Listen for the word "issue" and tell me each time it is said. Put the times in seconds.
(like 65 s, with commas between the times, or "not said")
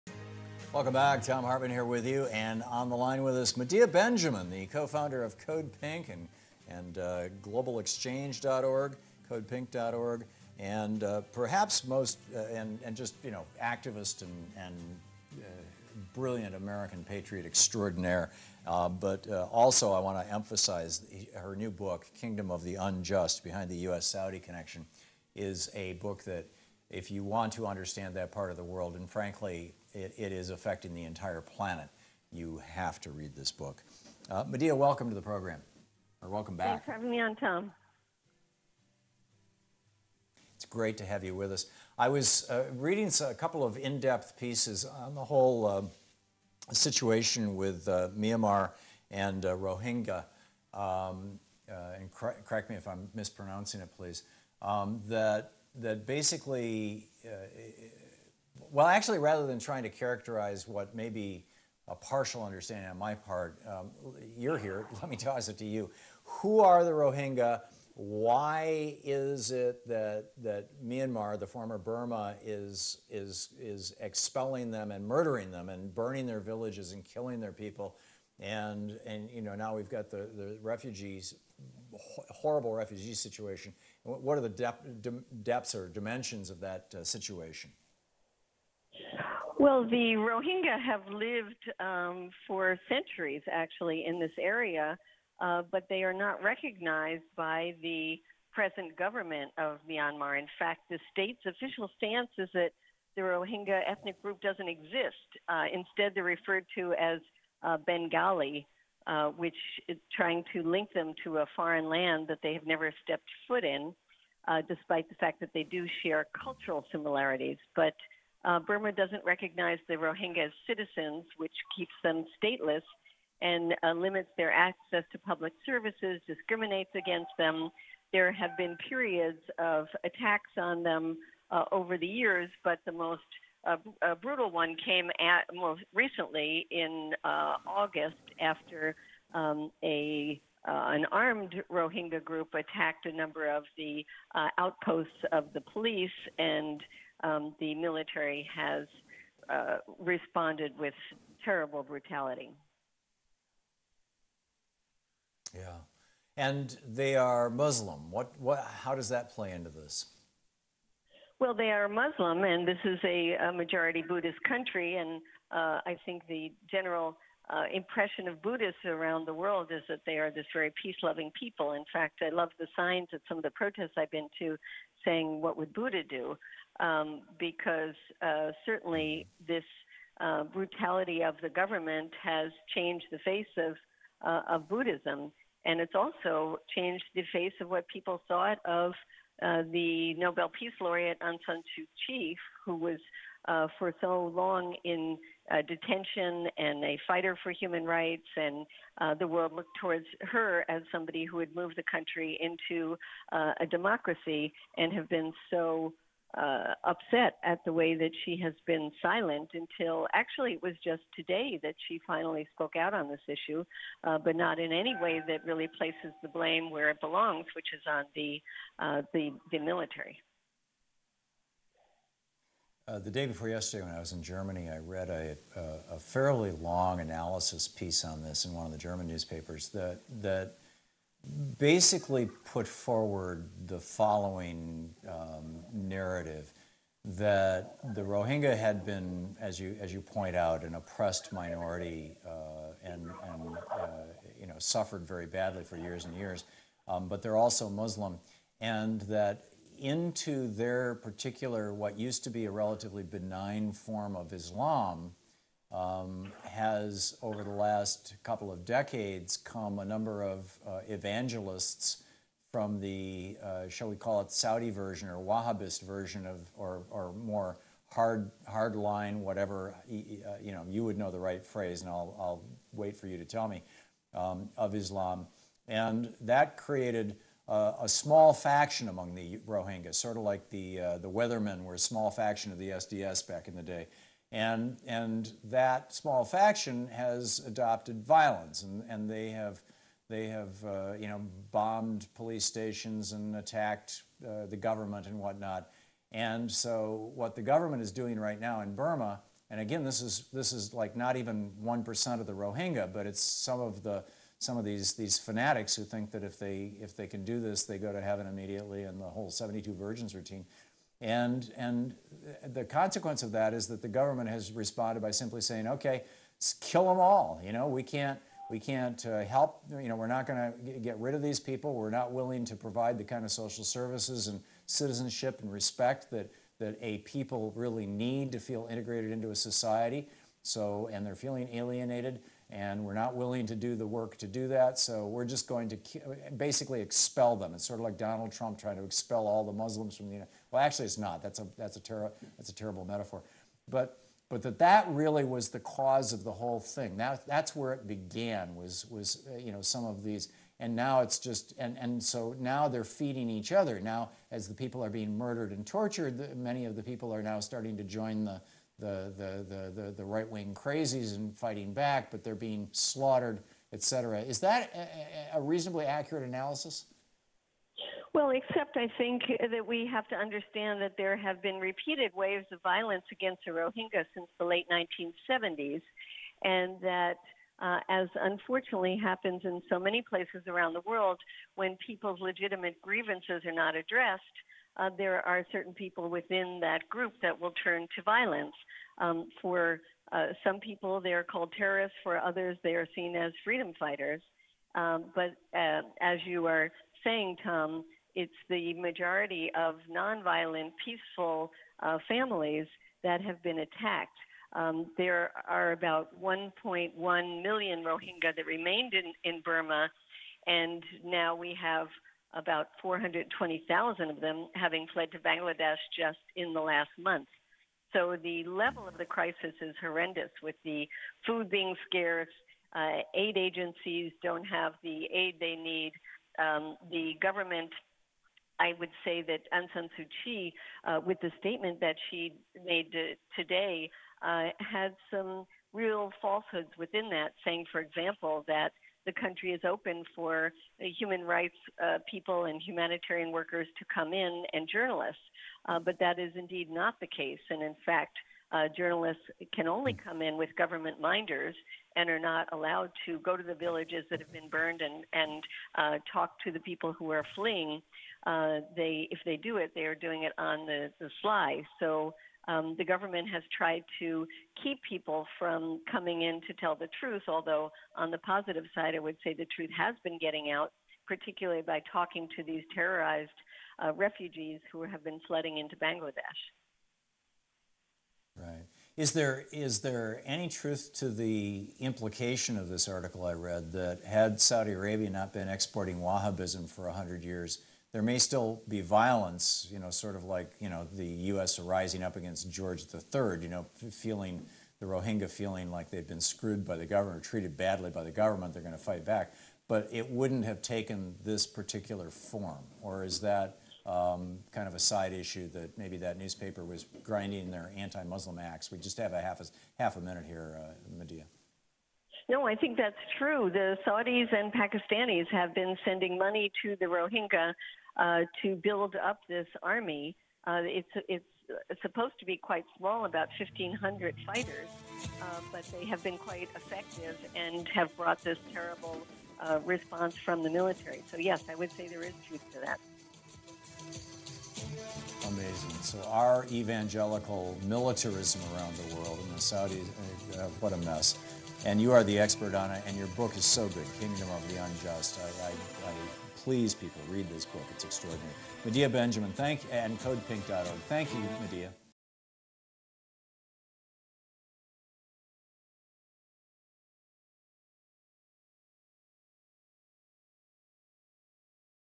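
213 s, 505 s.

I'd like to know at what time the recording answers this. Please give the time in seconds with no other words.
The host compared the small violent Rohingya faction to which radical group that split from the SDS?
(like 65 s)
280 s.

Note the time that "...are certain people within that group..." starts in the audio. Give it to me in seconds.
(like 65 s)
385 s.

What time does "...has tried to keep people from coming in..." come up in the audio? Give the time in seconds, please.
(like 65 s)
463 s.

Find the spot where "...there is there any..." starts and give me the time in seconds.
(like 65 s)
479 s.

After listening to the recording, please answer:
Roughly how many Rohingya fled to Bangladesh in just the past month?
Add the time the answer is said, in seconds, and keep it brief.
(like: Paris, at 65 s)
420,000, at 412 s.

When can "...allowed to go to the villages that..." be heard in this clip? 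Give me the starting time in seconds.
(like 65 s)
452 s.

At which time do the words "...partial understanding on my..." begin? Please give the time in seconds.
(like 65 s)
61 s.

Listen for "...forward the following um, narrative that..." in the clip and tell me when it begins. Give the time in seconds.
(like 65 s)
232 s.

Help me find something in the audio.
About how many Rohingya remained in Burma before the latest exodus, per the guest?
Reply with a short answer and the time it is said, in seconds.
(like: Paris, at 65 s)
1.1 million, at 406 s.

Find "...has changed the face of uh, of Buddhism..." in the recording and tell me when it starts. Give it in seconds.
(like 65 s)
182 s.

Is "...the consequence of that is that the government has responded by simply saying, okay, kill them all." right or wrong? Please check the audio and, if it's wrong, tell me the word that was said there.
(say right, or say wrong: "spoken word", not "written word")
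right.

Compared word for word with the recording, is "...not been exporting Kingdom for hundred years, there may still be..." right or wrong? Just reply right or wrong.
wrong.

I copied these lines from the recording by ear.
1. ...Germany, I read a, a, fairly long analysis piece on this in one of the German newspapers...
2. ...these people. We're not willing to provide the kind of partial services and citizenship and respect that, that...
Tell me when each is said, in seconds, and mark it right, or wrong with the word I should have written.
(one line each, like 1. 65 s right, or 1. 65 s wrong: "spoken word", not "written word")
1. 224 s right
2. 321 s wrong: "social", not "partial".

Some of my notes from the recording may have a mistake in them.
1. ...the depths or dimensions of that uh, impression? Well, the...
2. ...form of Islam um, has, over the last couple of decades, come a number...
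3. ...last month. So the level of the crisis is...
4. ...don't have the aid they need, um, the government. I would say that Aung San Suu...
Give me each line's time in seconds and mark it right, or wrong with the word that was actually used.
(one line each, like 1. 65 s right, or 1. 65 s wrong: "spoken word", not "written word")
1. 84 s wrong: "situation", not "impression"
2. 253 s right
3. 416 s right
4. 424 s right.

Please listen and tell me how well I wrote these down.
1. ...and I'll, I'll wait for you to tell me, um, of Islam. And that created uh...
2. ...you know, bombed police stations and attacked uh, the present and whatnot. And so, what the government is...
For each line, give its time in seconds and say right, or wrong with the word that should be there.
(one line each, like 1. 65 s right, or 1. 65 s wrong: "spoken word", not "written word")
1. 271 s right
2. 290 s wrong: "government", not "present".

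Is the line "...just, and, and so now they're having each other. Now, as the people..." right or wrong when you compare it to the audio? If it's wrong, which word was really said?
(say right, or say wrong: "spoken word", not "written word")
wrong: "feeding", not "having".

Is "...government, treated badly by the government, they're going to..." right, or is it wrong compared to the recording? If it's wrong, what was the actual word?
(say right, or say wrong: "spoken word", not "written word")
right.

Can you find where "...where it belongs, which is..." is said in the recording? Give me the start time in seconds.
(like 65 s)
216 s.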